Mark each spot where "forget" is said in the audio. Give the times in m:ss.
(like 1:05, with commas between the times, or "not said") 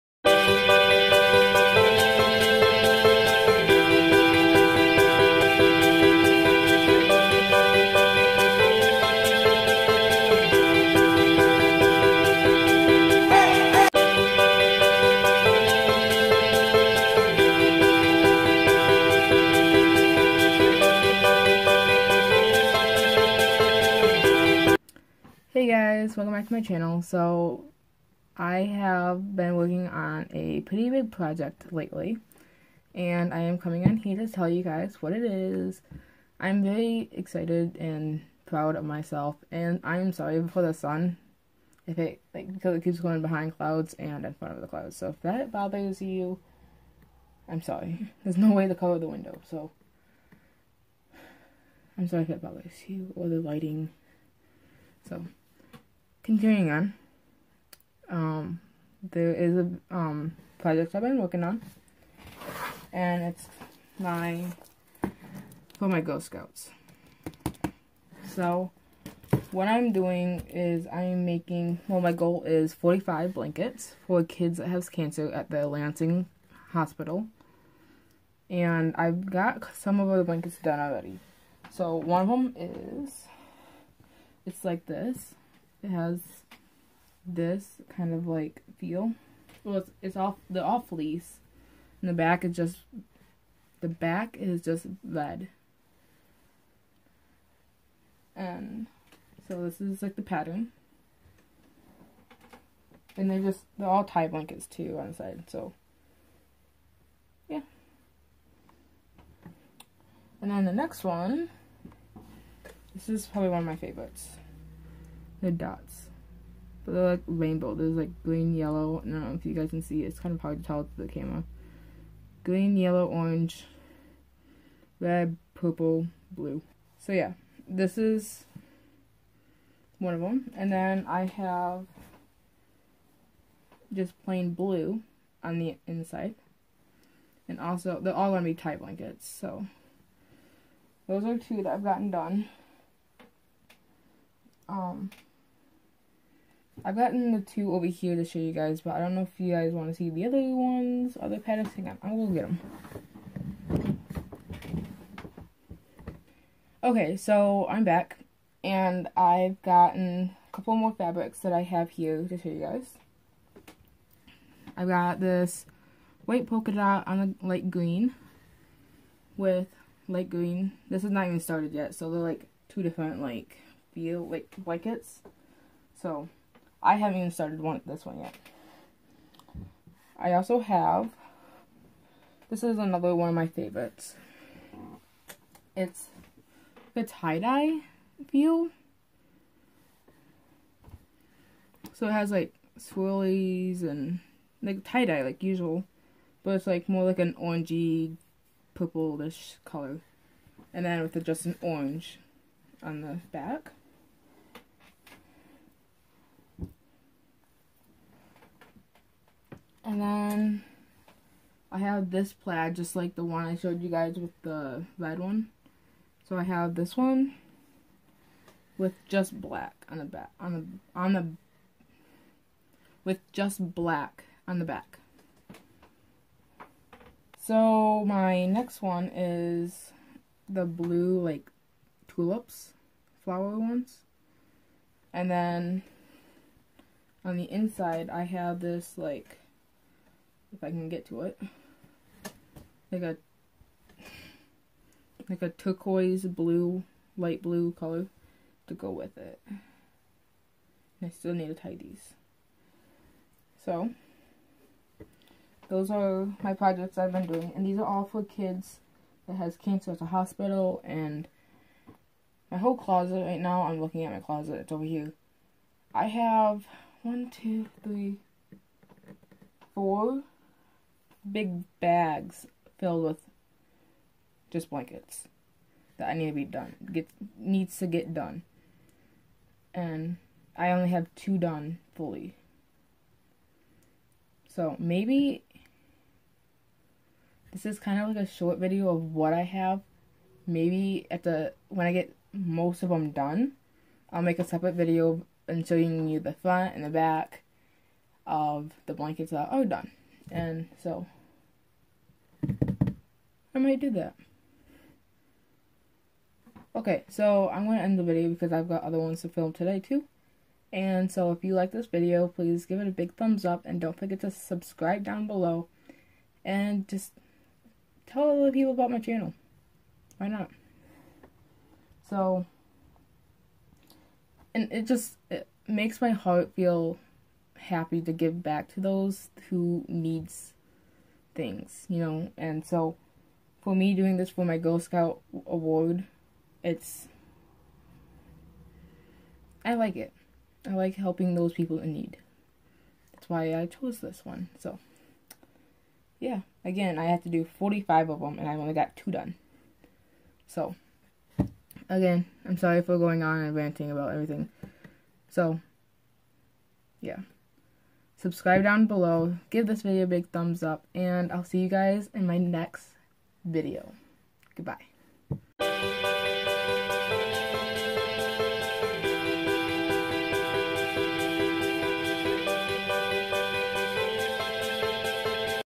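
5:13.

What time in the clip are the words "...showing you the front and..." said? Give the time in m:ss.
4:55.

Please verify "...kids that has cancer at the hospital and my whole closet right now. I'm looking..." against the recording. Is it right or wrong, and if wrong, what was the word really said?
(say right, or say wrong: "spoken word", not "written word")
right.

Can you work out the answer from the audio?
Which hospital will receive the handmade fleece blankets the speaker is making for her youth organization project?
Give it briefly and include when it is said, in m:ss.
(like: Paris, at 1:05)
Lansing Hospital, at 1:15.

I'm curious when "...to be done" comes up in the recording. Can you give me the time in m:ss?
4:36.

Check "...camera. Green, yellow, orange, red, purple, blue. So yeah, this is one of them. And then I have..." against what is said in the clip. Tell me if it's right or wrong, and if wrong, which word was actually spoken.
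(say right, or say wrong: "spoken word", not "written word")
right.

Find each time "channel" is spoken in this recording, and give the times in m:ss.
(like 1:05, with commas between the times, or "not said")
0:26, 5:18.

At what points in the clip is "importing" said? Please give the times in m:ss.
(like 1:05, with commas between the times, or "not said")
not said.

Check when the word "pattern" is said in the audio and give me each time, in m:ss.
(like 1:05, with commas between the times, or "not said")
1:40, 2:31.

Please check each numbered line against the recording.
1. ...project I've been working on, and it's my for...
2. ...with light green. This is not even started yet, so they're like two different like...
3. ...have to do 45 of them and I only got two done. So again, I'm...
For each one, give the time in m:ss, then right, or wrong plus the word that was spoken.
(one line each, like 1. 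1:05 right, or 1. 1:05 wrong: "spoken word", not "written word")
1. 1:00 right
2. 2:49 right
3. 5:47 right.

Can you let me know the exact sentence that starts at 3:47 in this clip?
So my next one is the blue, like, tulips, flower ones.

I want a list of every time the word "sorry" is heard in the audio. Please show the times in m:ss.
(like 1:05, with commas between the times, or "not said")
0:40, 0:47, 0:52, 5:52.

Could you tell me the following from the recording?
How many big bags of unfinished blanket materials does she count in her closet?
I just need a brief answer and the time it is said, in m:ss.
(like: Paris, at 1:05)
4, at 4:29.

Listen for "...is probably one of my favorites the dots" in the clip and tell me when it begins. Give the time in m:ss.
1:53.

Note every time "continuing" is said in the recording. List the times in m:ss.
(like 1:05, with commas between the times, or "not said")
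0:56.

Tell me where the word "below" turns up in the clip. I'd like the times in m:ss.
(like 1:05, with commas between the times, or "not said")
5:15, 5:58.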